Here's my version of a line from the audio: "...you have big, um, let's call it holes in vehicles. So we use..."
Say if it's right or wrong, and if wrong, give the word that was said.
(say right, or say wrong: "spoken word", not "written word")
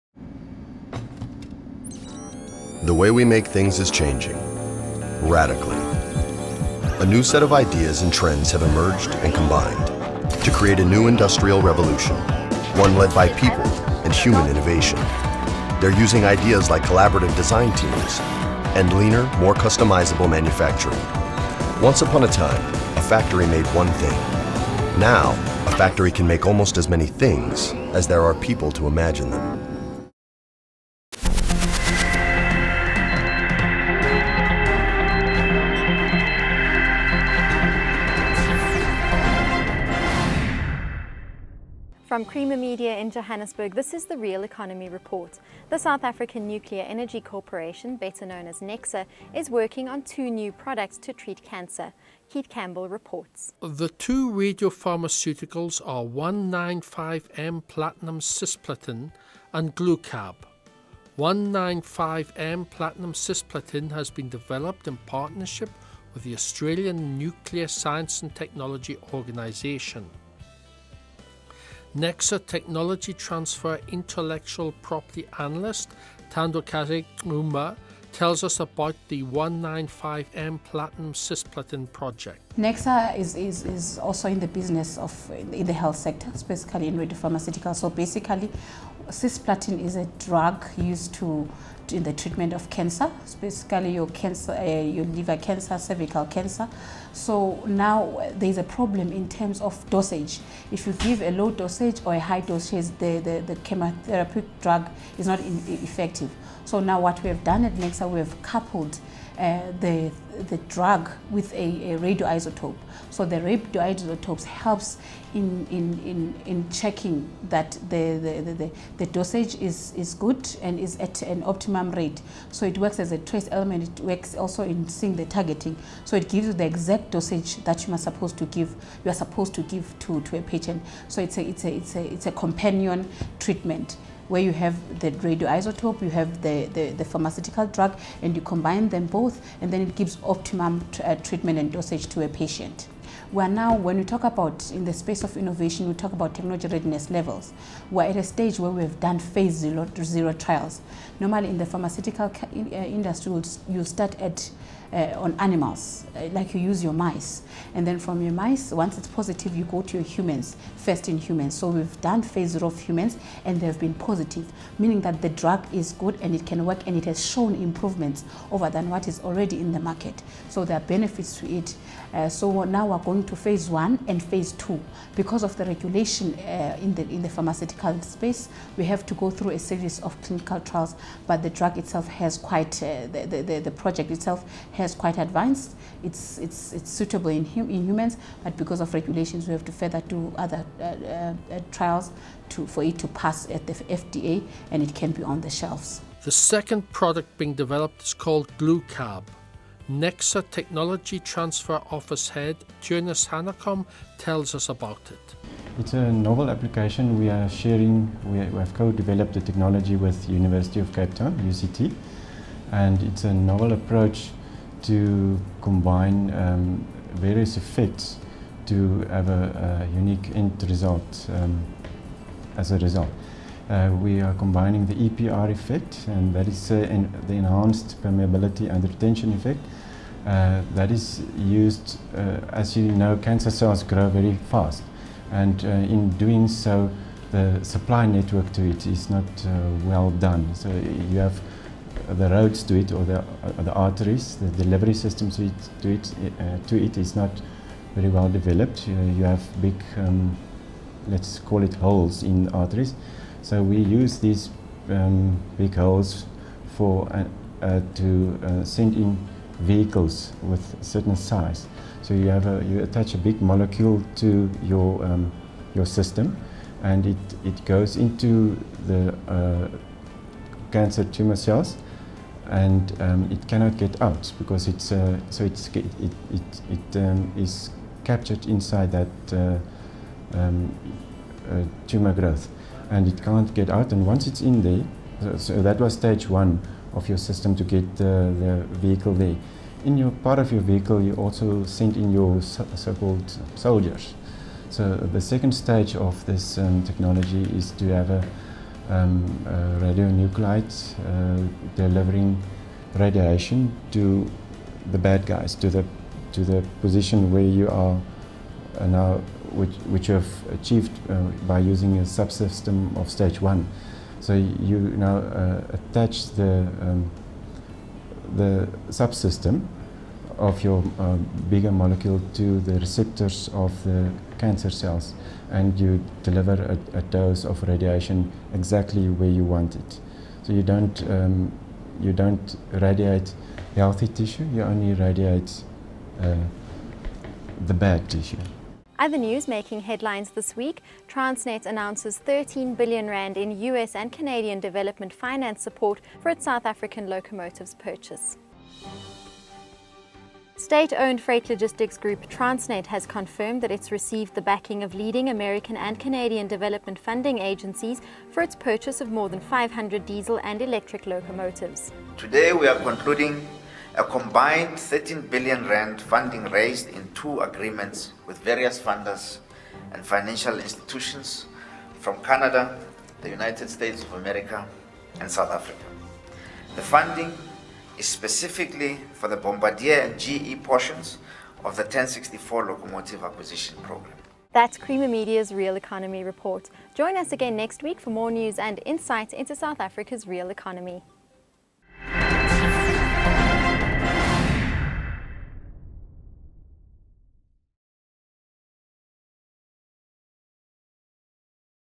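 wrong: "arteries", not "vehicles".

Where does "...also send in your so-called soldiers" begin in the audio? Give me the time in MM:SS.
04:51.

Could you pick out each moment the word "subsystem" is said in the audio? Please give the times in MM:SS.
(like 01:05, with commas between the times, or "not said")
05:12, 05:18.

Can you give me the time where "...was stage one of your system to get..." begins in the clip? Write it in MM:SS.
04:45.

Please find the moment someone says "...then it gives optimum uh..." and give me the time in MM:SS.
02:19.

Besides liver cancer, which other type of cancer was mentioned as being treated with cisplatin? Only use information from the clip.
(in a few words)
cervical cancer.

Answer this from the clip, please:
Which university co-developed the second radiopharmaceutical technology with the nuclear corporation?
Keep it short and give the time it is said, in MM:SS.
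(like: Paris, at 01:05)
University of Cape Town, at 03:30.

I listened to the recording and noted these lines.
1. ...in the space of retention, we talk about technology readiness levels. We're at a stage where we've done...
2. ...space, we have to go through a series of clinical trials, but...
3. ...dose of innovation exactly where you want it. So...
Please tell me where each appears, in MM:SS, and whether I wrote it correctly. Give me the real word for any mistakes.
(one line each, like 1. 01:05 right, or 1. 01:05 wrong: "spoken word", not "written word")
1. 02:24 wrong: "innovation", not "retention"
2. 02:58 right
3. 05:27 wrong: "radiation", not "innovation".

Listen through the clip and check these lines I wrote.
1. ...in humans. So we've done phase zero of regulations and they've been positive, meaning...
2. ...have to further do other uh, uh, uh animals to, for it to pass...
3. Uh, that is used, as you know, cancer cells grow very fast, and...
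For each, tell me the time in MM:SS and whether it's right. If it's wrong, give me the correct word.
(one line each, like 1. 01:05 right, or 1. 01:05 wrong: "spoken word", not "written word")
1. 02:41 wrong: "humans", not "regulations"
2. 03:09 wrong: "trials", not "animals"
3. 03:50 right.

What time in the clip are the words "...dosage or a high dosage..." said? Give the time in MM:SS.
01:41.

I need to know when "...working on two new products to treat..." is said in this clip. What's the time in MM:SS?
00:49.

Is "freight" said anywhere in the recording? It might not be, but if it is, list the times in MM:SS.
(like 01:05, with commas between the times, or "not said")
05:51.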